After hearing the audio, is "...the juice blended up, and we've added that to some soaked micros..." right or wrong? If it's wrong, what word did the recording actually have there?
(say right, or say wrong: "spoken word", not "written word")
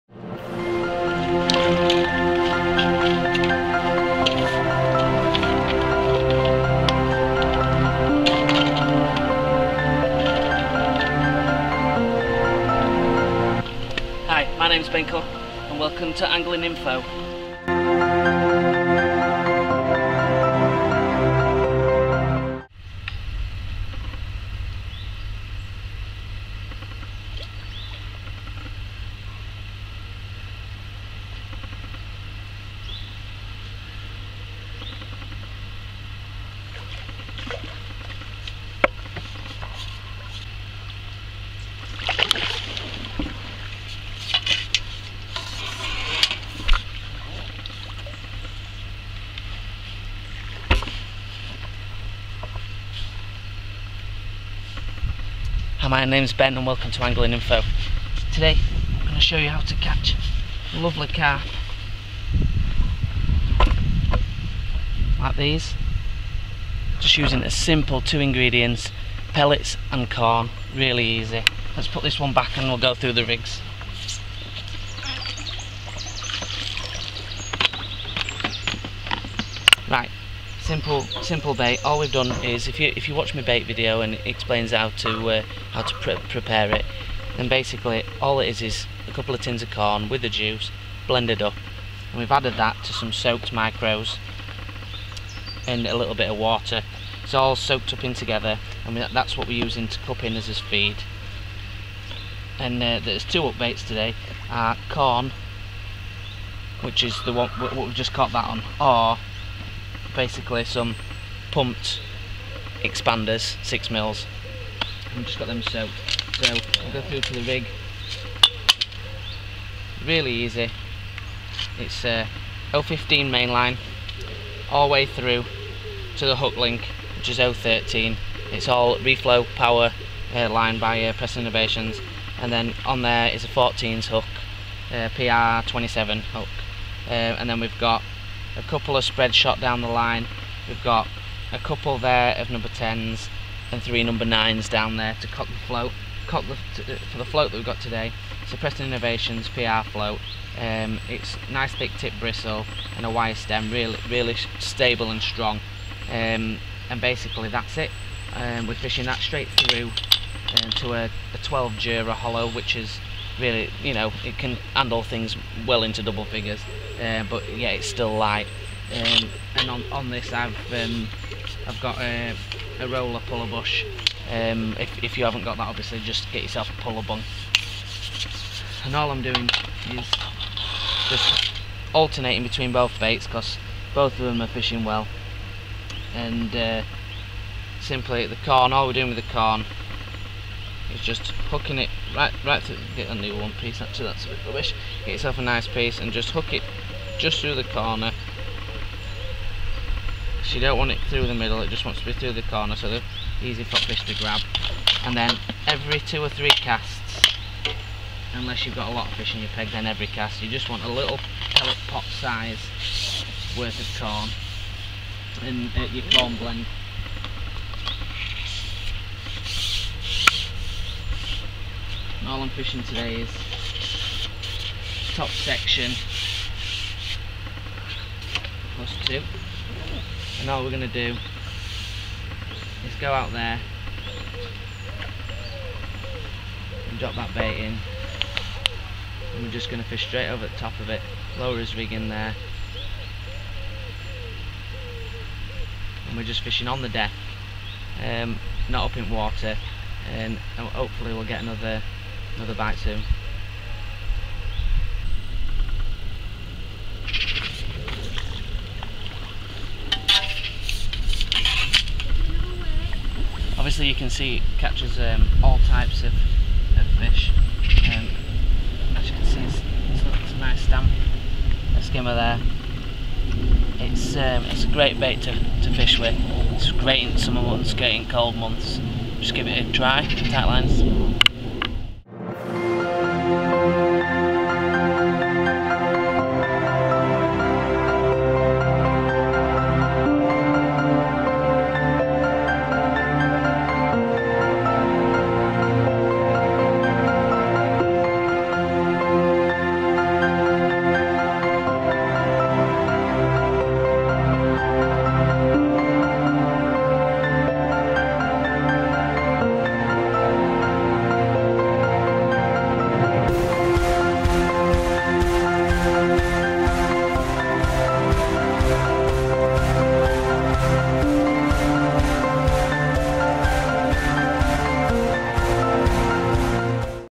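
right.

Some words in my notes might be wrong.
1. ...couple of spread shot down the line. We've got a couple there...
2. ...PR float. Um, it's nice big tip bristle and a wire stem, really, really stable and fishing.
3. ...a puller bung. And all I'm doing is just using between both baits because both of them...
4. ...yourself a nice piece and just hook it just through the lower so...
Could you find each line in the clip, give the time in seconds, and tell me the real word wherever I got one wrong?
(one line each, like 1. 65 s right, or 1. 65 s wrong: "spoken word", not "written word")
1. 138 s right
2. 149 s wrong: "strong", not "fishing"
3. 176 s wrong: "alternating", not "using"
4. 195 s wrong: "corner", not "lower".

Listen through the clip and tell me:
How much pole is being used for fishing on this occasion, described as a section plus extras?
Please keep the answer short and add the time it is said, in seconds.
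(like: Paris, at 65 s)
top section plus two, at 225 s.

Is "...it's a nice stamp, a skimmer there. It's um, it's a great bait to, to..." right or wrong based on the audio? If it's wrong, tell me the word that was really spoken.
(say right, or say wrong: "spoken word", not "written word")
right.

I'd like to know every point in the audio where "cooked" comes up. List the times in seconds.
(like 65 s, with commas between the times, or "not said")
not said.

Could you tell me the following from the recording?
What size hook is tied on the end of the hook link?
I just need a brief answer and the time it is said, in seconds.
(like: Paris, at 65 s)
14, at 133 s.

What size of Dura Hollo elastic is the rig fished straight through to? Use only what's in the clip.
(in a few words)
12.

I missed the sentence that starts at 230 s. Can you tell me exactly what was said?
And all we're gonna do is go out there and drop that bait in.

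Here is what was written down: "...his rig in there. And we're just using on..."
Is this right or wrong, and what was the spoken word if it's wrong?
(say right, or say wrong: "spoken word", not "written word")
wrong: "fishing", not "using".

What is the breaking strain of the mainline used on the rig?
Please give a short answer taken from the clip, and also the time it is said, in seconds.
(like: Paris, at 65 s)
15, at 122 s.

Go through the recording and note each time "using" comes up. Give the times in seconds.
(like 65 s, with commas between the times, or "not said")
67 s, 99 s.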